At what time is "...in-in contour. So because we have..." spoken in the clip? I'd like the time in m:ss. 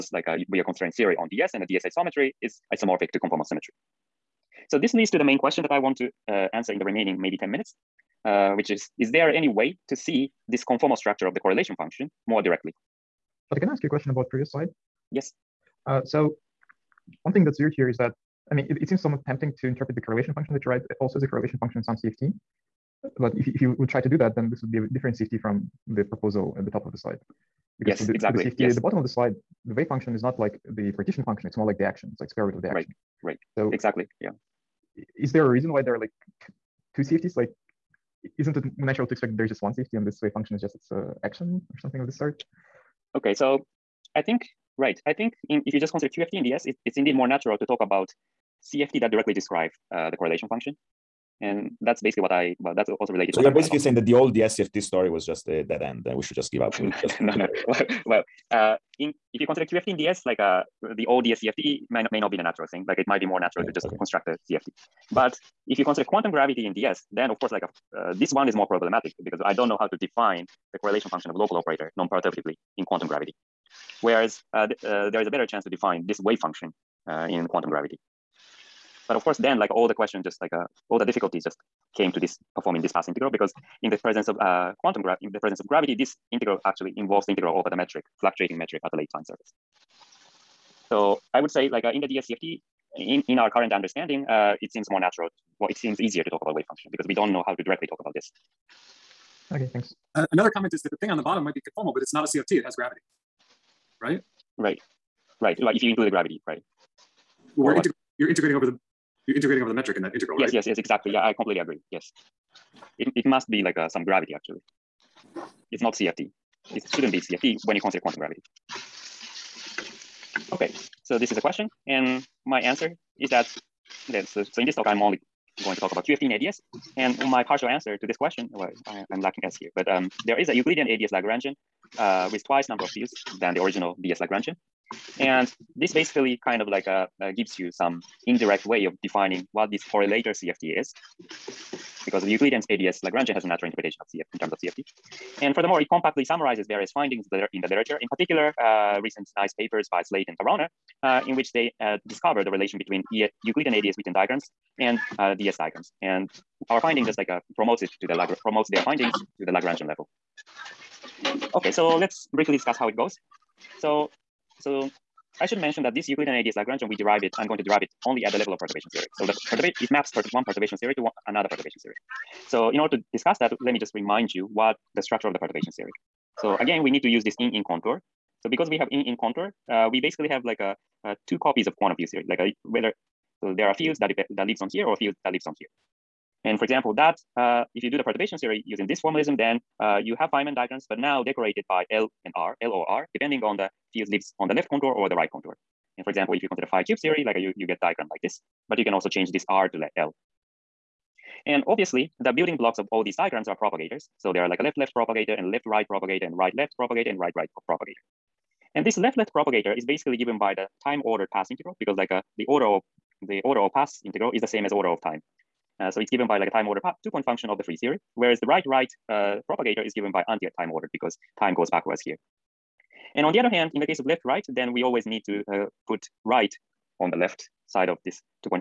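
2:57.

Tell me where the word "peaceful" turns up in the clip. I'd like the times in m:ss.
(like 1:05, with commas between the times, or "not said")
not said.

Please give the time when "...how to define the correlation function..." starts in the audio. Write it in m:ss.
1:09.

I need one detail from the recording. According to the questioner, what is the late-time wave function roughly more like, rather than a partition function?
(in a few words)
Square root of the action.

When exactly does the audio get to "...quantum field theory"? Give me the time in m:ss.
3:01.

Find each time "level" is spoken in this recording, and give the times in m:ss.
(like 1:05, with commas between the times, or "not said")
2:39, 2:48.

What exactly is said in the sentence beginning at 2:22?
Because the Euclidean ADS Lagrangian has a natural interpretation of CFT in terms of CFT.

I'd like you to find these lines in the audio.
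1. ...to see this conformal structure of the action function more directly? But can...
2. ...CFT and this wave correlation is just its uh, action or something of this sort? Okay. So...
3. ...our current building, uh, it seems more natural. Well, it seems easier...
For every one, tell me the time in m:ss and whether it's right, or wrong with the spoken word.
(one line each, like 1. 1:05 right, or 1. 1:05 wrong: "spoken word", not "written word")
1. 0:09 wrong: "correlation", not "action"
2. 0:39 wrong: "function", not "correlation"
3. 1:33 wrong: "understanding", not "building".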